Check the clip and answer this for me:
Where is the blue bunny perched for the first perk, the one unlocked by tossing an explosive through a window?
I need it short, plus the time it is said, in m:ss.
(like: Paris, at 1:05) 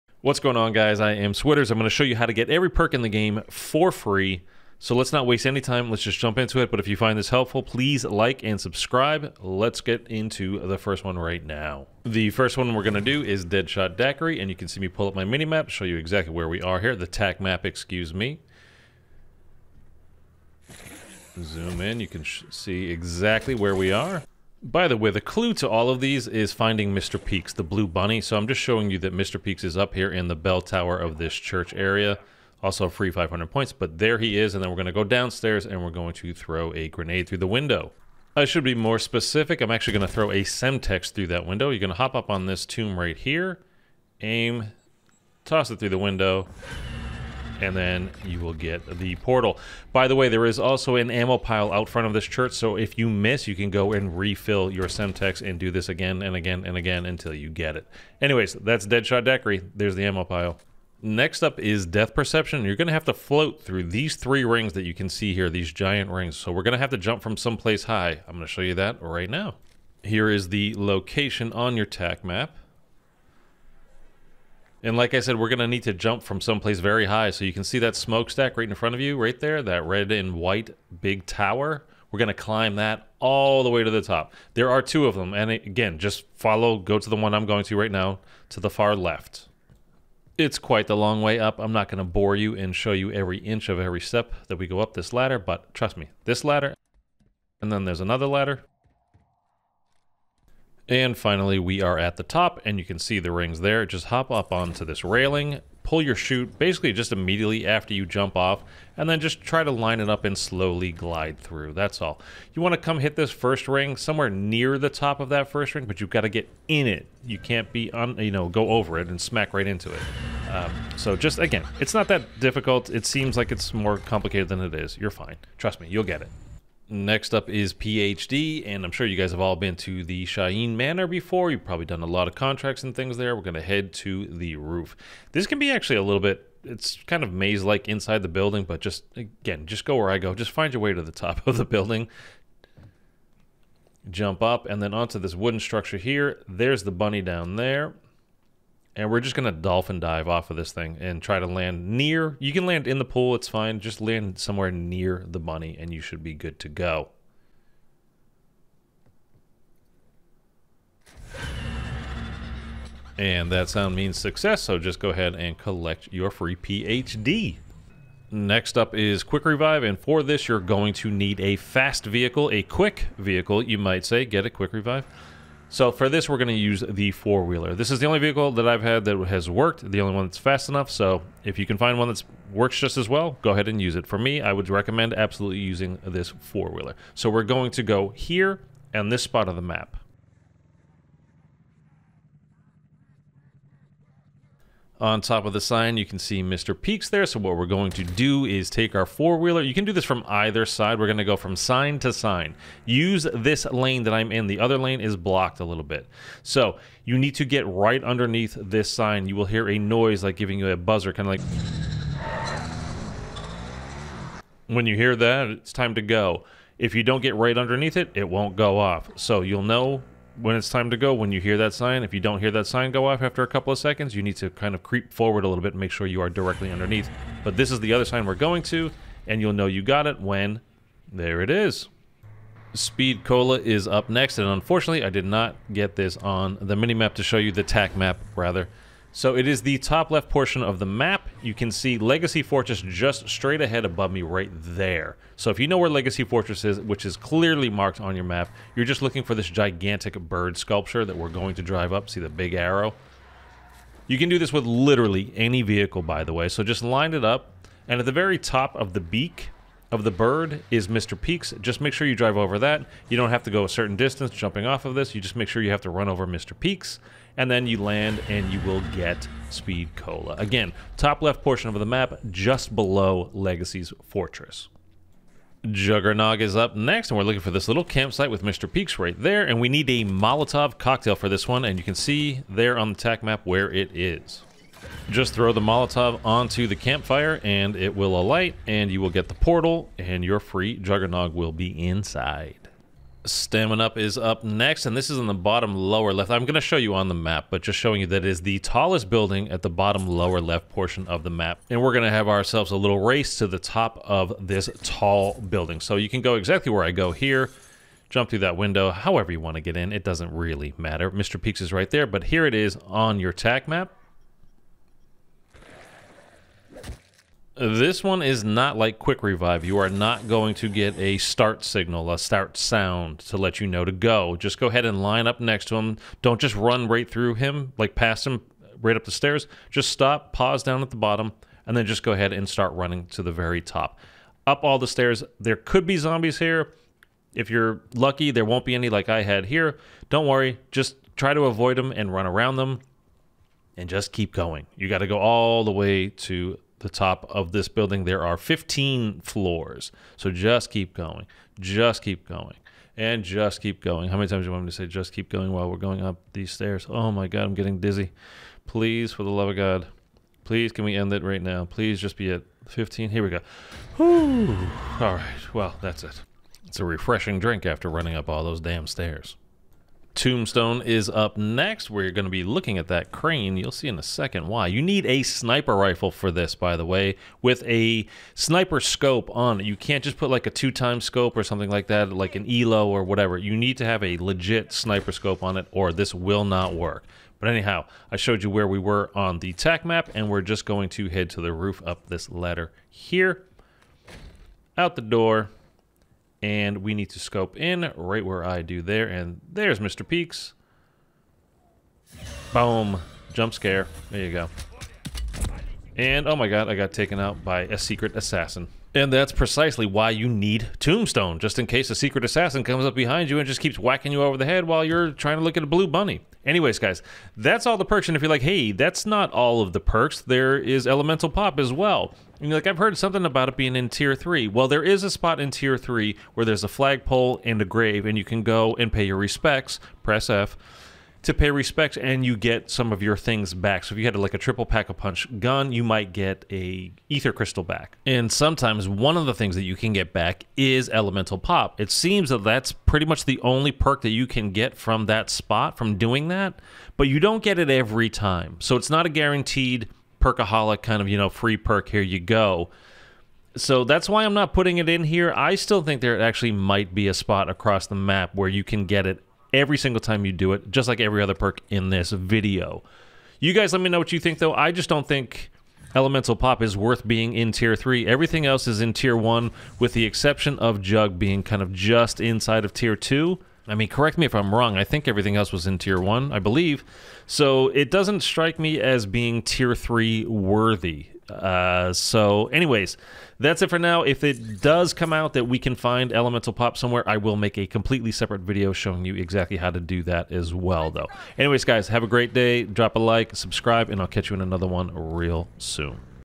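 bell tower, at 0:30.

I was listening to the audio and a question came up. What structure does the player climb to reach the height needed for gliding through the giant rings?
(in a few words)
smokestack.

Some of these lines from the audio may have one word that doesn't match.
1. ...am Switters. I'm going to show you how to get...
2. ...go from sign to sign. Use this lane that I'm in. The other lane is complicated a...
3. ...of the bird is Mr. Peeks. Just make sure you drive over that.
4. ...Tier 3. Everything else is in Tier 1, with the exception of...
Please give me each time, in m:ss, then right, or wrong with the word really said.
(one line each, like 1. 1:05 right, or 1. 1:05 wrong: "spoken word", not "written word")
1. 0:01 right
2. 3:21 wrong: "blocked", not "complicated"
3. 4:19 right
4. 7:47 right.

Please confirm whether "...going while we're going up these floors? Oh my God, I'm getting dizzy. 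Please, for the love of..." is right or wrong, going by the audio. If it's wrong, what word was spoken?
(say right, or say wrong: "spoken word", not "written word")
wrong: "stairs", not "floors".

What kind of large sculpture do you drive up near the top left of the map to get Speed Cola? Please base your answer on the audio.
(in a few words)
bird sculpture.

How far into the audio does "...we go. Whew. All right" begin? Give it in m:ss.
6:03.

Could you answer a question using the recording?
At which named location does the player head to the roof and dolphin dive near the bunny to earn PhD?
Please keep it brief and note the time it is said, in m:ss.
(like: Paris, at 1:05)
Shahin Manor, at 2:10.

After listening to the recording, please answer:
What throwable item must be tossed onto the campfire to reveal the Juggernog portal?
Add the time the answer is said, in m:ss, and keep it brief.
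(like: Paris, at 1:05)
Molotov cocktail, at 4:40.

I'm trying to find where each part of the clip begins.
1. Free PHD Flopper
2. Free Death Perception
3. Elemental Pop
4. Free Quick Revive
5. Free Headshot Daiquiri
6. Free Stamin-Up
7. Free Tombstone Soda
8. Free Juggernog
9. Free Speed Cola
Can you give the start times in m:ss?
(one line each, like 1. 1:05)
1. 2:06
2. 1:00
3. 6:58
4. 2:48
5. 0:12
6. 4:53
7. 6:10
8. 4:35
9. 3:52.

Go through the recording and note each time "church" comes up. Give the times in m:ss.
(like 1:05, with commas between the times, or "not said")
0:31, 0:52.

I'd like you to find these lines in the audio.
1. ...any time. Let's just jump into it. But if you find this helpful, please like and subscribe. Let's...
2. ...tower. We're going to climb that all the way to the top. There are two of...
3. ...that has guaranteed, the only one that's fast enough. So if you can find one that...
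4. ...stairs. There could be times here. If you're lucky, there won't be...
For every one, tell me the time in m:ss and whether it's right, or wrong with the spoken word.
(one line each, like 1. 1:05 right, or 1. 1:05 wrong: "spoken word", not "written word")
1. 0:05 right
2. 1:21 right
3. 2:59 wrong: "worked", not "guaranteed"
4. 5:34 wrong: "zombies", not "times".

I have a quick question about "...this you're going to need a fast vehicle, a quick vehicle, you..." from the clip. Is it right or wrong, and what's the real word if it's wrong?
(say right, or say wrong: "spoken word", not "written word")
right.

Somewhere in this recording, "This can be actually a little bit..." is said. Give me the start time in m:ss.
2:15.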